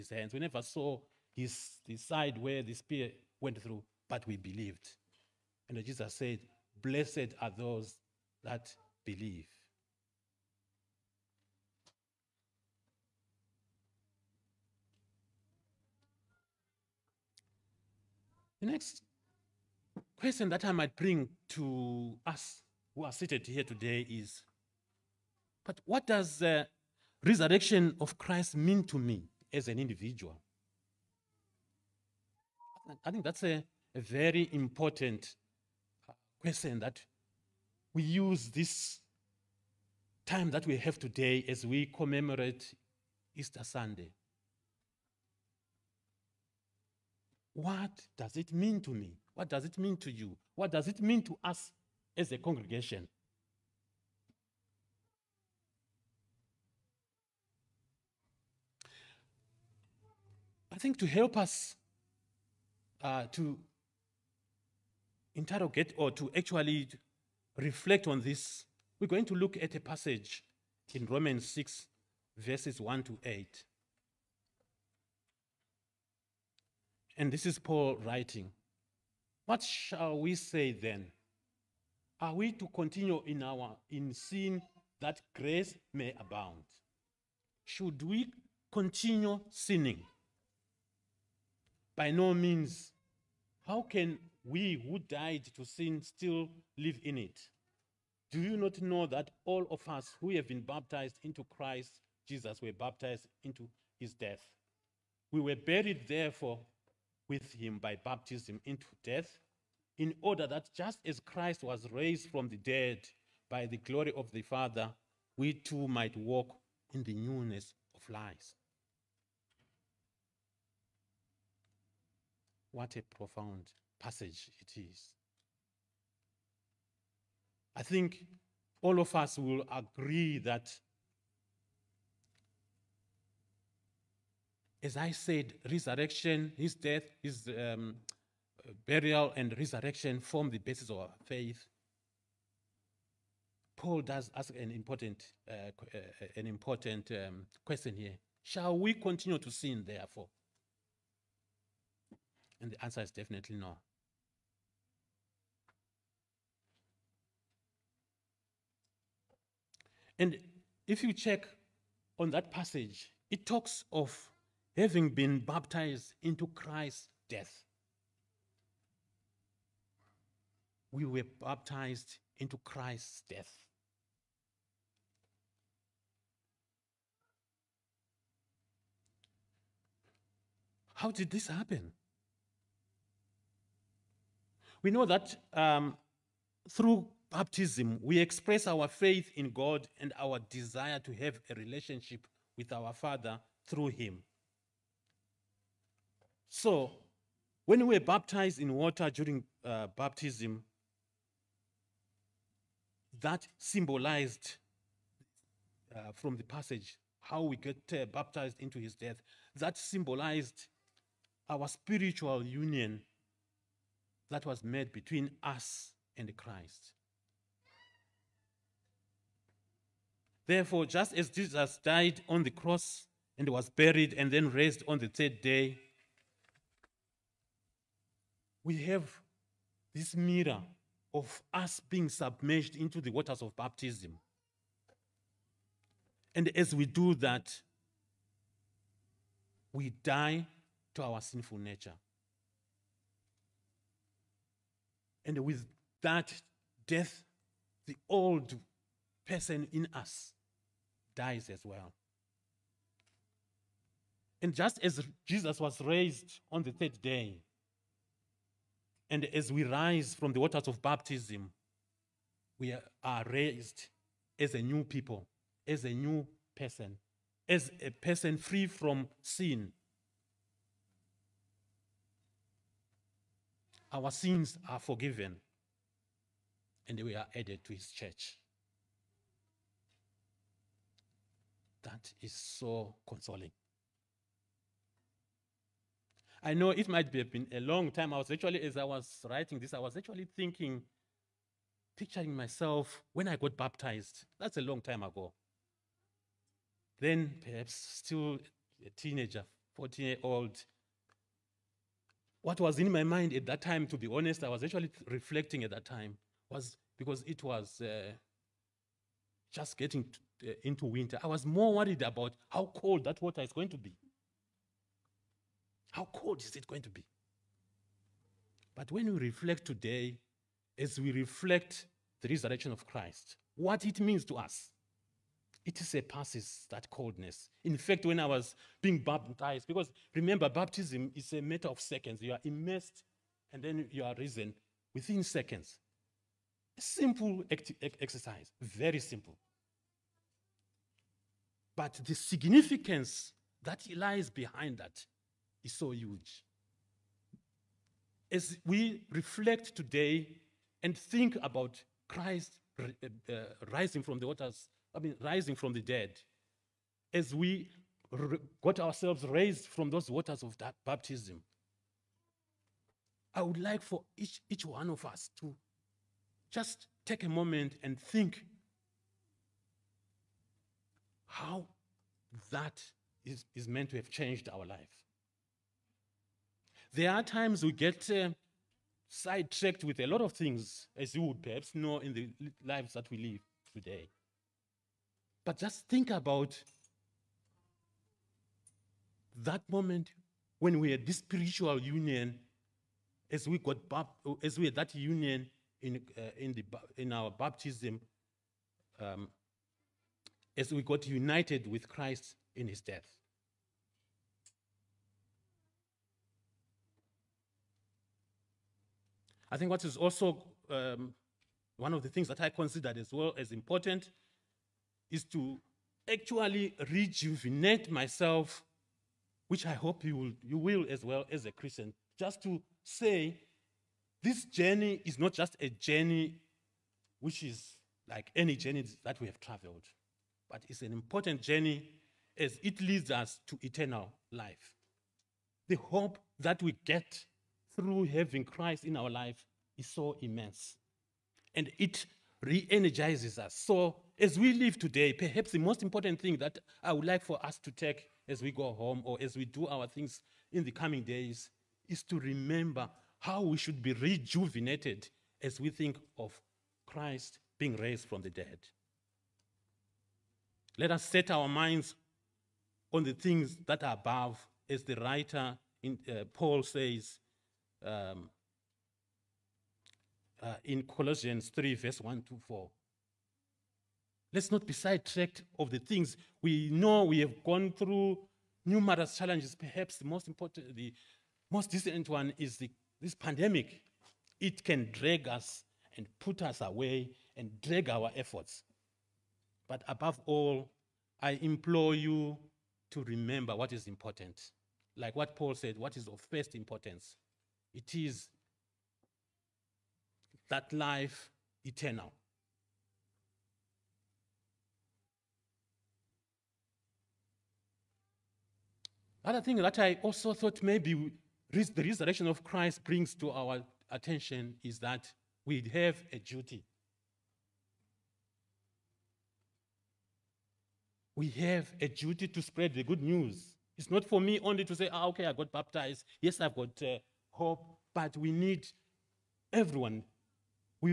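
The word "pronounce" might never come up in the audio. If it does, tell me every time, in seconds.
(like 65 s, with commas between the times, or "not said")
not said.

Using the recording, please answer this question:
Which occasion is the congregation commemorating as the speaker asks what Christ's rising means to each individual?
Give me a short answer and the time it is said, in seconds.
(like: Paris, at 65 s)
Easter Sunday, at 43 s.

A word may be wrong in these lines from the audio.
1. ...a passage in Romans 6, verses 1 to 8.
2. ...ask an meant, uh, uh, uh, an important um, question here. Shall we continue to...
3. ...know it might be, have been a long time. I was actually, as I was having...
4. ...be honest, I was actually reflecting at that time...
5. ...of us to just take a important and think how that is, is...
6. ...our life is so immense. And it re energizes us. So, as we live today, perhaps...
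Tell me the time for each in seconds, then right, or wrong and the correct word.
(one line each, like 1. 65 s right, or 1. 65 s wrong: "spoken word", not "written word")
1. 69 s right
2. 144 s wrong: "important", not "meant"
3. 286 s wrong: "writing", not "having"
4. 303 s right
5. 364 s wrong: "moment", not "important"
6. 438 s right.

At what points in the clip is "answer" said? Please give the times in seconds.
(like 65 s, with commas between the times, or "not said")
152 s.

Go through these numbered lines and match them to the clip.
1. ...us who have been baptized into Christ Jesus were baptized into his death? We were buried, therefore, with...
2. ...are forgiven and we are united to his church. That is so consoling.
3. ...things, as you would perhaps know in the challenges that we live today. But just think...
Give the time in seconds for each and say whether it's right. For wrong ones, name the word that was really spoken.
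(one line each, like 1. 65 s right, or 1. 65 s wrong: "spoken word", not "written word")
1. 99 s right
2. 274 s wrong: "added", not "united"
3. 380 s wrong: "lives", not "challenges".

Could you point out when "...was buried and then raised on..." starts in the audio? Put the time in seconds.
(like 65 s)
223 s.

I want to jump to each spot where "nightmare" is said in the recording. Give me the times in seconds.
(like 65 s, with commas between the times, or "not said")
not said.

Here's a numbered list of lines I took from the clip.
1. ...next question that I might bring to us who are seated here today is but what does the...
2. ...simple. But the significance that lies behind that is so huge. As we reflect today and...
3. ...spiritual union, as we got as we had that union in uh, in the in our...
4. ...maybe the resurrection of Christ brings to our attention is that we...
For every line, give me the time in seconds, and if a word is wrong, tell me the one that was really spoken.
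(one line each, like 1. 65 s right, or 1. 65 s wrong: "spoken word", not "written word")
1. 18 s right
2. 338 s right
3. 391 s right
4. 510 s right.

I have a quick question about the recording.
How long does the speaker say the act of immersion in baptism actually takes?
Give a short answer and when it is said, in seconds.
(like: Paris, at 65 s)
A matter of seconds, at 331 s.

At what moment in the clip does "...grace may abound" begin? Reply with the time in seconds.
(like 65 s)
85 s.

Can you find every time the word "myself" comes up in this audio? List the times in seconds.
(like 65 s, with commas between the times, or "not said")
292 s, 417 s.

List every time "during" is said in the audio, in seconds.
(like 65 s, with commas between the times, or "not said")
199 s.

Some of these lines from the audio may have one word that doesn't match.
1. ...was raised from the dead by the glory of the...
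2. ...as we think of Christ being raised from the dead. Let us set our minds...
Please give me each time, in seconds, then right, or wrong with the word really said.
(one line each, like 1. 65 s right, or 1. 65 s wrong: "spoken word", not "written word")
1. 111 s right
2. 455 s right.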